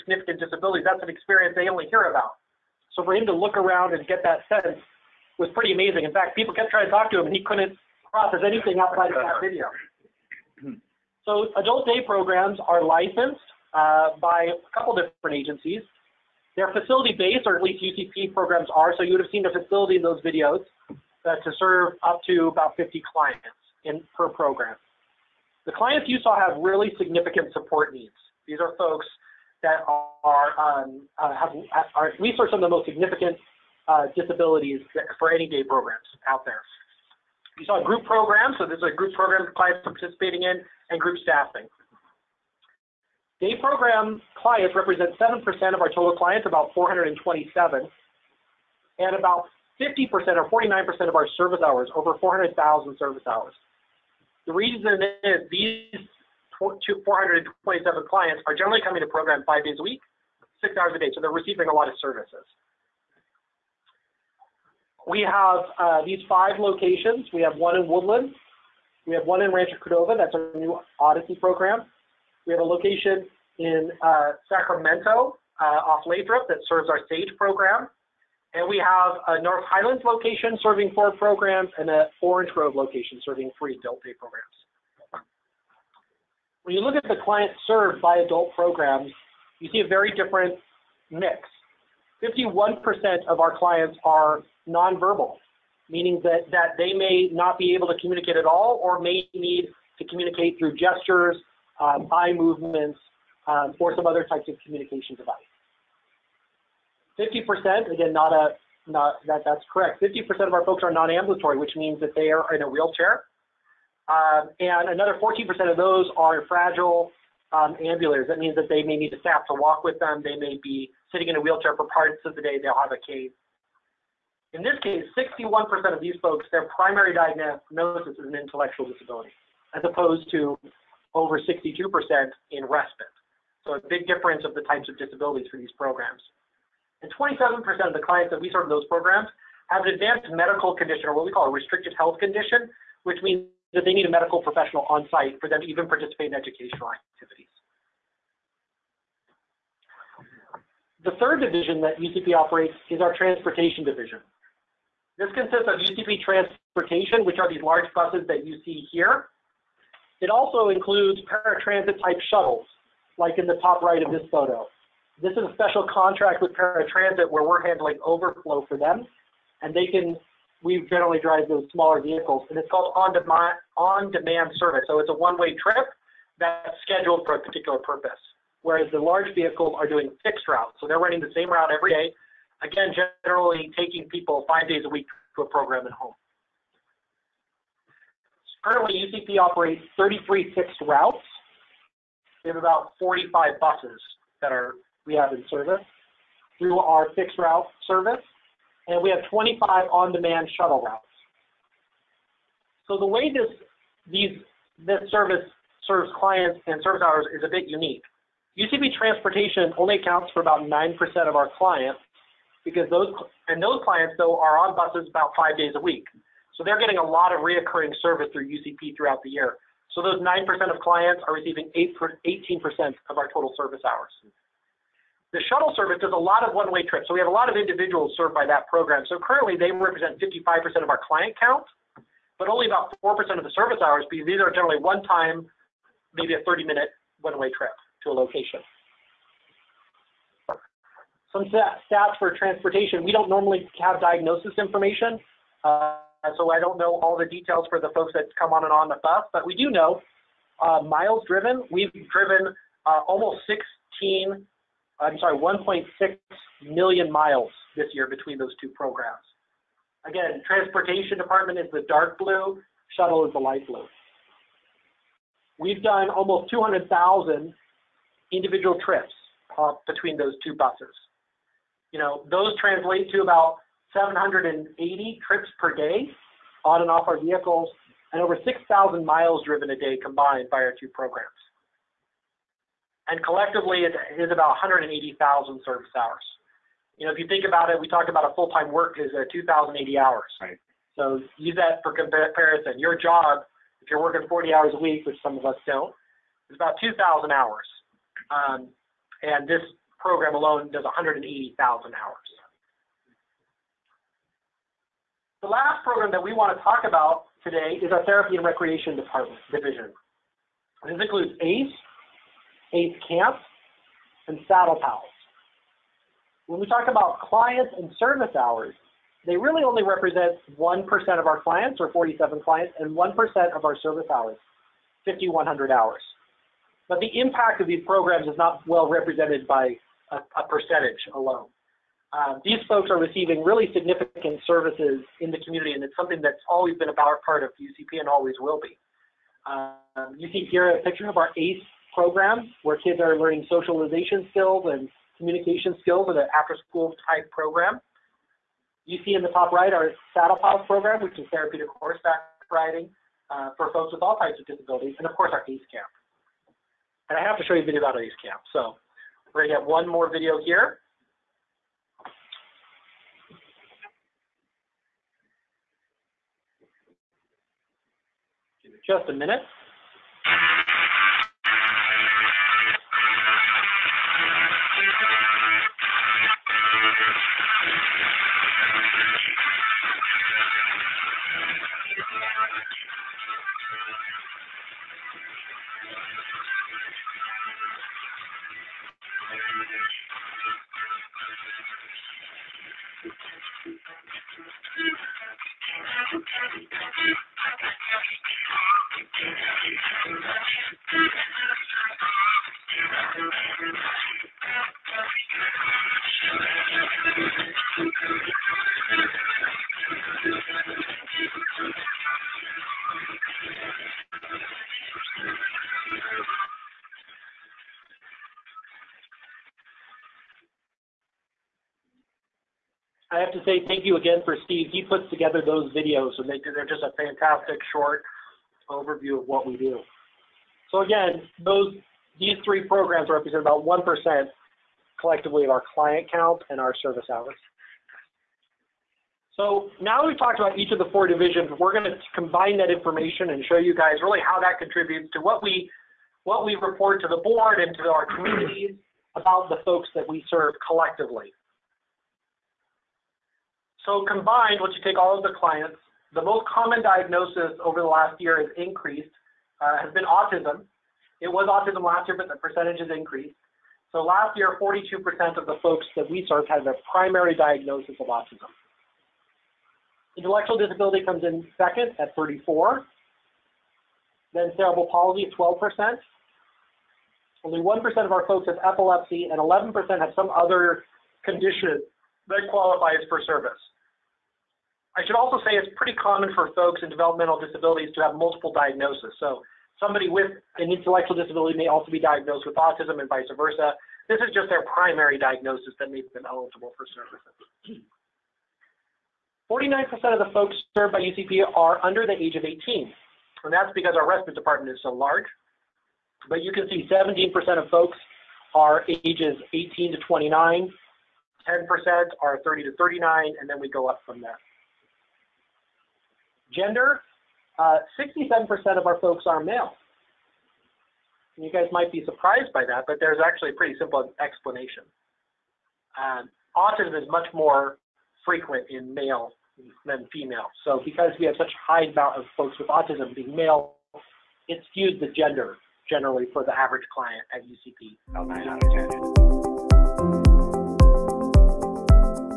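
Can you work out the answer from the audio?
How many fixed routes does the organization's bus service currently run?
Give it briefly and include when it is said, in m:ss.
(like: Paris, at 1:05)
33, at 3:09.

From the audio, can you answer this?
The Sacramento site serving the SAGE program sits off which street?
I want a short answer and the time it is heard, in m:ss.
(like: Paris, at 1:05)
Lathrop, at 1:16.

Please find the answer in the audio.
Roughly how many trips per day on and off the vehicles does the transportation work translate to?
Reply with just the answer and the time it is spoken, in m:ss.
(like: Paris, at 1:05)
780, at 4:33.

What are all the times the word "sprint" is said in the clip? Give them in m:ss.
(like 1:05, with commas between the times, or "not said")
not said.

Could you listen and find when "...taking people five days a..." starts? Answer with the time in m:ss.
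3:03.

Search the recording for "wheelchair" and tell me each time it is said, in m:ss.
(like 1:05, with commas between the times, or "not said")
1:52, 2:01.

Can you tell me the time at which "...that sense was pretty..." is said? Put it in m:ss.
0:04.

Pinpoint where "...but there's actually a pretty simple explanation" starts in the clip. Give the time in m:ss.
8:42.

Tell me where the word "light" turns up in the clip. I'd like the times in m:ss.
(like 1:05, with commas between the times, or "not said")
4:23.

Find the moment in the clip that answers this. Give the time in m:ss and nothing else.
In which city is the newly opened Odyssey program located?
1:09.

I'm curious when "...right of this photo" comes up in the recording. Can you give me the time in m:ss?
2:43.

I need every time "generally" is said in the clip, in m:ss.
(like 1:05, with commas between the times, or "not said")
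0:58, 2:50, 3:03, 3:54, 8:55.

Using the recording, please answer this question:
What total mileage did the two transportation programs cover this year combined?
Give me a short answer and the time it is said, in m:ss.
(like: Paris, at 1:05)
1.6 million miles, at 4:15.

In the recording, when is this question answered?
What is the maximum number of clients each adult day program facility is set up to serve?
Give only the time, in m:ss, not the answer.
0:22.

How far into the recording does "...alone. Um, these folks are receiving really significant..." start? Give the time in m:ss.
5:31.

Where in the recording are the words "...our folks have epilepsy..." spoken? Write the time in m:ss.
7:58.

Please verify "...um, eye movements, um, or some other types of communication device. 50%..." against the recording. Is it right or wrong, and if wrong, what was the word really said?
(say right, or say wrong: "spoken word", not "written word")
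right.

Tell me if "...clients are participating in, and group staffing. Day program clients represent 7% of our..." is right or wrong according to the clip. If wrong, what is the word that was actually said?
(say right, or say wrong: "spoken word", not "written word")
right.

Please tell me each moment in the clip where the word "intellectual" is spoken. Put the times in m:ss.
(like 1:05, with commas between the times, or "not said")
2:08, 7:50, 8:10.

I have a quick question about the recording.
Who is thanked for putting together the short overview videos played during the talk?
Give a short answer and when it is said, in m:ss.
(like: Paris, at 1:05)
Steve, at 7:04.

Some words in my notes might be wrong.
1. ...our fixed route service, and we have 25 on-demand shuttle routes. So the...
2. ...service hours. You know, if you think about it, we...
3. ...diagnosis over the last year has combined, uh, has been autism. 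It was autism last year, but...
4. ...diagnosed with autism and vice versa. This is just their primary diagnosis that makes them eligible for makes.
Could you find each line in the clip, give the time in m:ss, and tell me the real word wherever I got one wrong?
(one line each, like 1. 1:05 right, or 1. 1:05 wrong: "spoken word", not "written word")
1. 3:16 right
2. 4:45 right
3. 7:36 wrong: "increased", not "combined"
4. 8:11 wrong: "services", not "makes".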